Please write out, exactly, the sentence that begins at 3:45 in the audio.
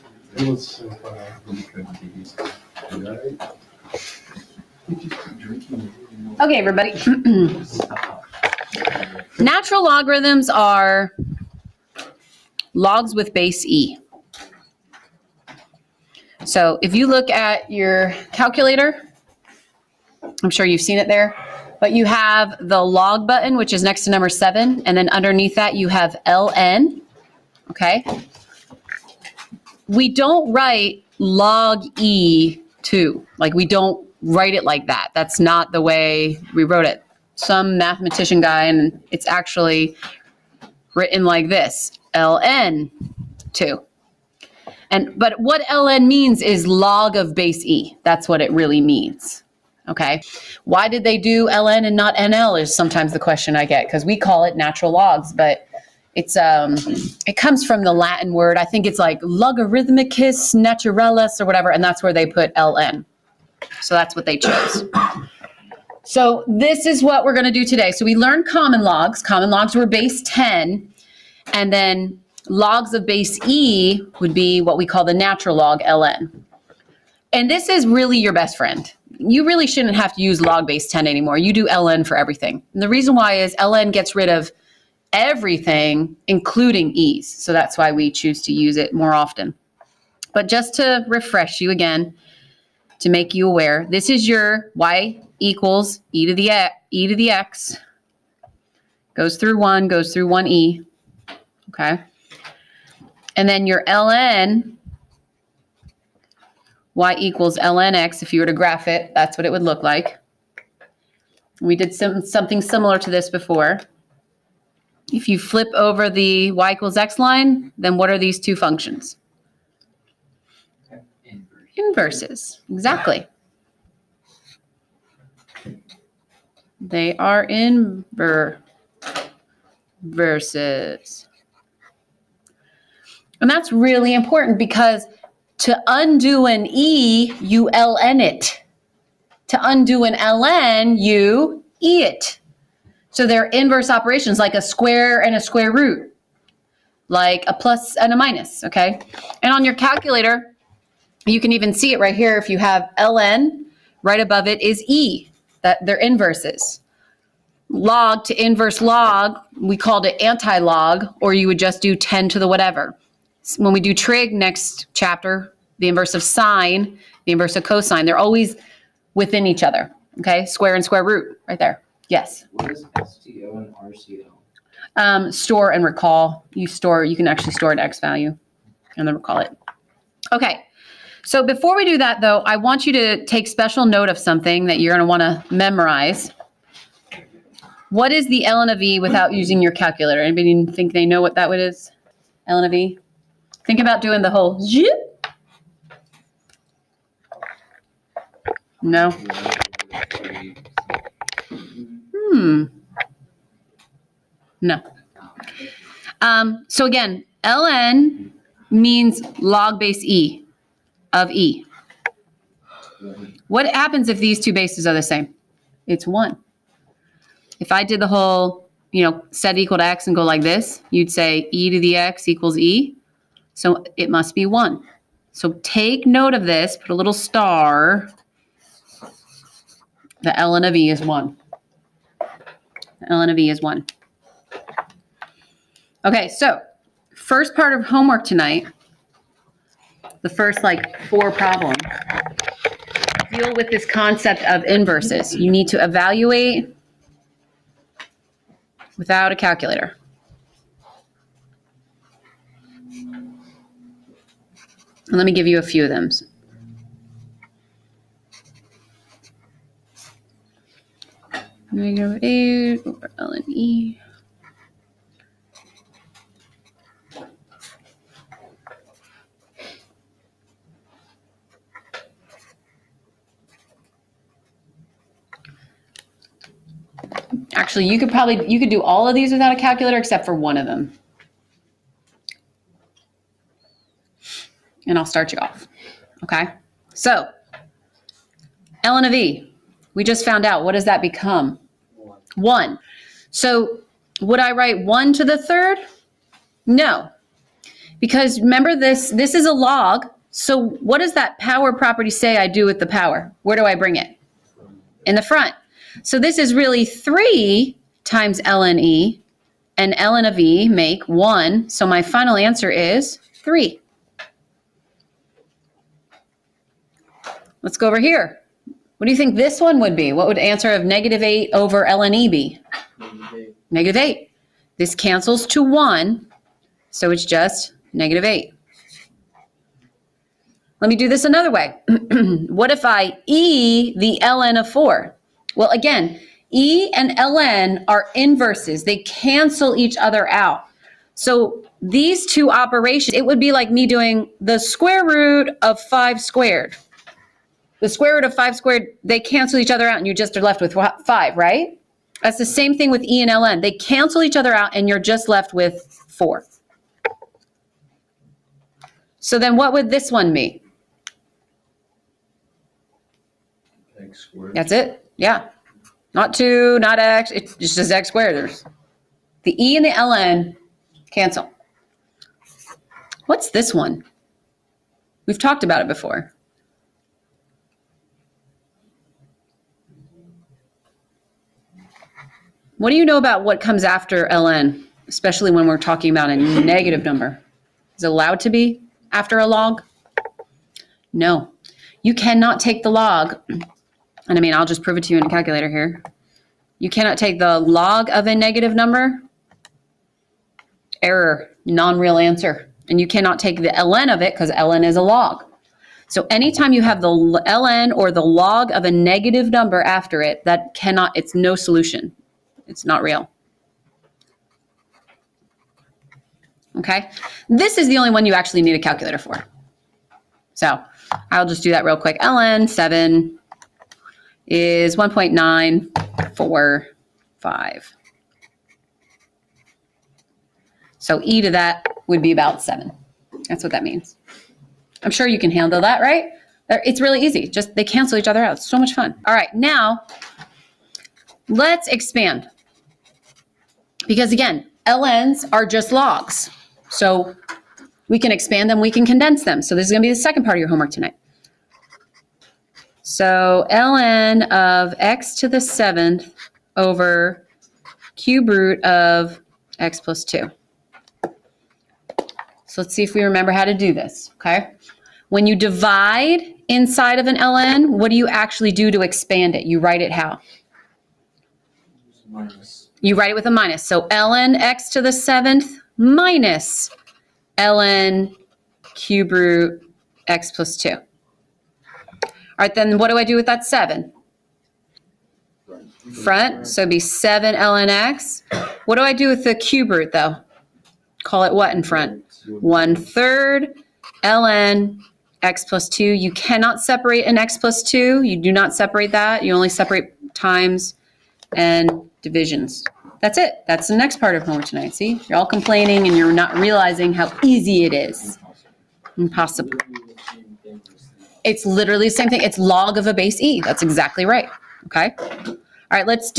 So take note of this, put a little star.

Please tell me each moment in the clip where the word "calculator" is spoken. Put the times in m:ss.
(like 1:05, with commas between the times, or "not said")
0:18, 2:29, 3:09, 4:09, 4:39, 6:35, 6:58.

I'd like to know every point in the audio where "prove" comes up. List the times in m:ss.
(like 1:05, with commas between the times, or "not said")
6:34.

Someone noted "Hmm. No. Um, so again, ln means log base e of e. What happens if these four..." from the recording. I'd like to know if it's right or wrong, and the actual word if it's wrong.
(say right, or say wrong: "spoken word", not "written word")
wrong: "two", not "four".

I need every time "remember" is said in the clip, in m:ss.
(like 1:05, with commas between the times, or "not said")
4:58, 7:43.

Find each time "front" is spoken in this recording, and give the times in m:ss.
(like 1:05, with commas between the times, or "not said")
5:05, 8:06, 8:11.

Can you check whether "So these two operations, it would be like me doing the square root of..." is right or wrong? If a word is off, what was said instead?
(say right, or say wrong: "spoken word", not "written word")
right.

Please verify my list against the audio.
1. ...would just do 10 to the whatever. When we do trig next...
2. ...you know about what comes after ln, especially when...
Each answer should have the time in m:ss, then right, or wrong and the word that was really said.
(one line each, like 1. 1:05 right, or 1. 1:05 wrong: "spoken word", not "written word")
1. 2:41 right
2. 6:22 right.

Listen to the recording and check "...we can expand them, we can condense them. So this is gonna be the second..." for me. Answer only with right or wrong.
right.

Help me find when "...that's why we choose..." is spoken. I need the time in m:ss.
1:27.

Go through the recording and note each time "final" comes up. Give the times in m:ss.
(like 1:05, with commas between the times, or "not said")
5:12.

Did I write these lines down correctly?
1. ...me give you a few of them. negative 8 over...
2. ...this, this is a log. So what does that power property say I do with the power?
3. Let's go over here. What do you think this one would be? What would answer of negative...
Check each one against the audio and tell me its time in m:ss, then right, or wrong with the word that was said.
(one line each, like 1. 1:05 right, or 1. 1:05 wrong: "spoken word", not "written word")
1. 4:15 right
2. 4:58 right
3. 5:17 right.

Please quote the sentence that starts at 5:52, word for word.
That's the same thing with E and LN.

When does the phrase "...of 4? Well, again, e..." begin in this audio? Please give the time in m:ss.
5:34.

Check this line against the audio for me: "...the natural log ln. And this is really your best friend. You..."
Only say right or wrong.
right.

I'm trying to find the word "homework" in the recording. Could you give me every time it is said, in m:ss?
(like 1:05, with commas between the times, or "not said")
3:57, 7:30, 8:24.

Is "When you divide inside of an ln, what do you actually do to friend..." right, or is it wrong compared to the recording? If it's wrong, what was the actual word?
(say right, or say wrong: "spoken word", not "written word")
wrong: "expand", not "friend".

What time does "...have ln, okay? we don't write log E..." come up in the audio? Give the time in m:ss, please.
0:25.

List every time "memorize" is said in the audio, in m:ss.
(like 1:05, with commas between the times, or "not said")
3:05.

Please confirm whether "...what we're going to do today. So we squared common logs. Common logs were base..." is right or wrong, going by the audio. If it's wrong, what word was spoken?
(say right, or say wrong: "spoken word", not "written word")
wrong: "learned", not "squared".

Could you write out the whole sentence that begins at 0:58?
I think it's like logarithmicus naturalis or whatever, and that's where they put ln.